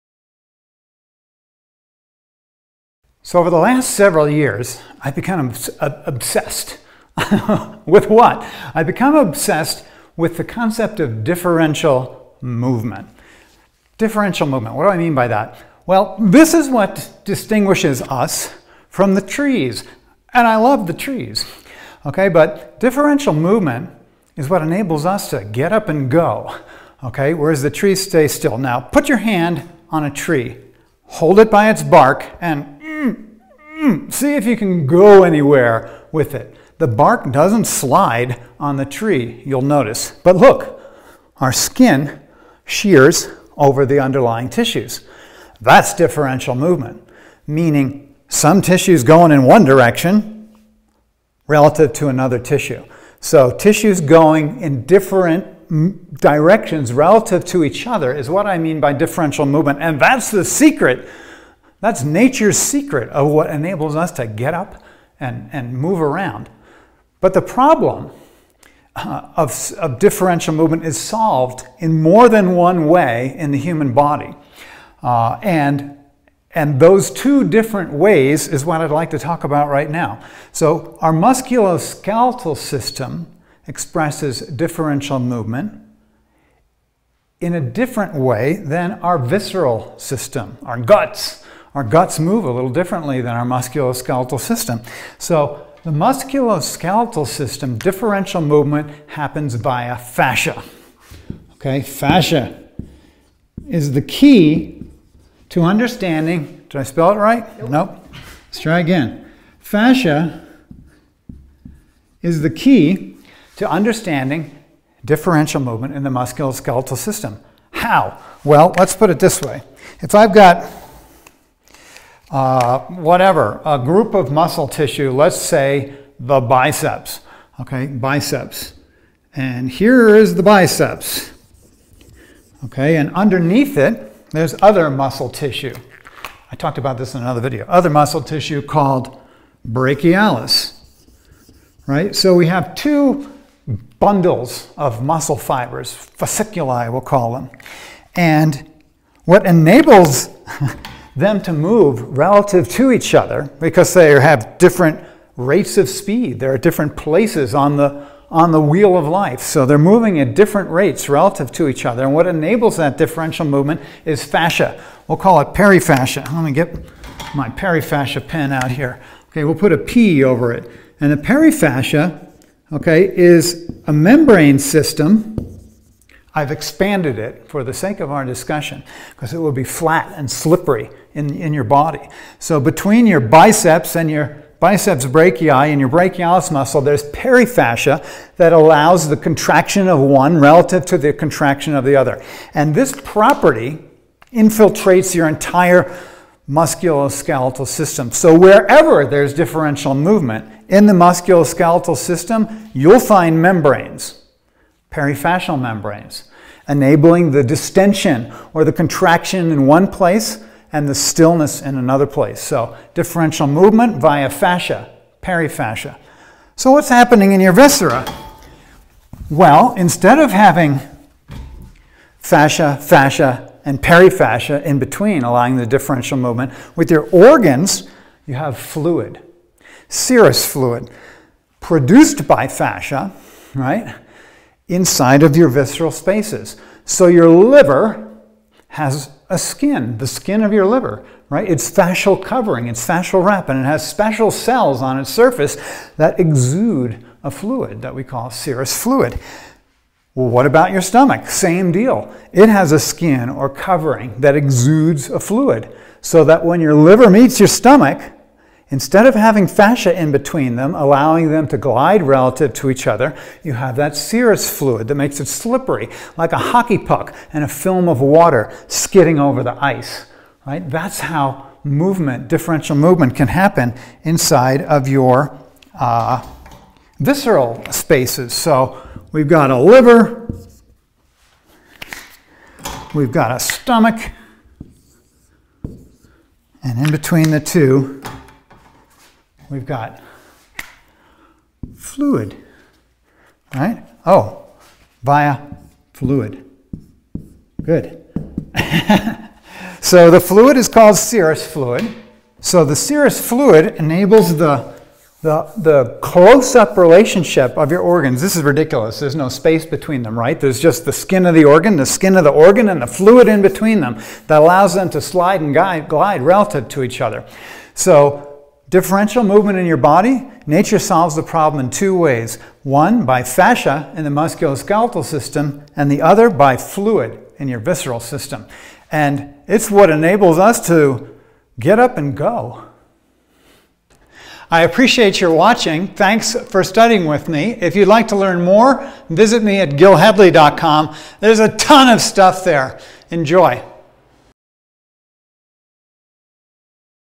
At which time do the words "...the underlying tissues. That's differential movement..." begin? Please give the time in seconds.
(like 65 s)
43 s.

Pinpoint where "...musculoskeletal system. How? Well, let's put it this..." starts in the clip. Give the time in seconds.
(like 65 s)
116 s.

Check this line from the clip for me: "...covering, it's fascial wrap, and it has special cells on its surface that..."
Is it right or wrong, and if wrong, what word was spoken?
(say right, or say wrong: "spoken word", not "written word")
right.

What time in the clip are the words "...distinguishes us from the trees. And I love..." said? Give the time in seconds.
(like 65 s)
17 s.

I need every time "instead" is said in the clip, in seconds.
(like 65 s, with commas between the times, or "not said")
219 s, 258 s.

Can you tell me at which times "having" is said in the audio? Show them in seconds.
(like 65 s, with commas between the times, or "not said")
220 s, 259 s.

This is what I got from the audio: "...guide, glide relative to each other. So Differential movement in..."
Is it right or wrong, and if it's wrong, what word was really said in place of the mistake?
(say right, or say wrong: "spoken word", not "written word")
right.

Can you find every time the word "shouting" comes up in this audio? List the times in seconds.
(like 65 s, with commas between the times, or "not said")
not said.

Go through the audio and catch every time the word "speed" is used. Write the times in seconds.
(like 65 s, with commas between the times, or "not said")
155 s.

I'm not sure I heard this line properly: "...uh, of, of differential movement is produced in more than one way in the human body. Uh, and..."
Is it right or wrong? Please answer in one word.
wrong.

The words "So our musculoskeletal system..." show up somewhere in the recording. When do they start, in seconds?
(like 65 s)
80 s.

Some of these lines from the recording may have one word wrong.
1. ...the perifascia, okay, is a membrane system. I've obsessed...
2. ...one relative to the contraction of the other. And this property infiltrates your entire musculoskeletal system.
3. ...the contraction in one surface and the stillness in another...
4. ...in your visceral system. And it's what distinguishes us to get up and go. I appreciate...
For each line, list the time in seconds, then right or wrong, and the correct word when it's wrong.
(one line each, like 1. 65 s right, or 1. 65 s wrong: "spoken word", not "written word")
1. 171 s wrong: "expanded", not "obsessed"
2. 189 s right
3. 208 s wrong: "place", not "surface"
4. 327 s wrong: "enables", not "distinguishes".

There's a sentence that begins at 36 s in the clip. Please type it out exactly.
The bark doesn't slide on the tree, you'll notice.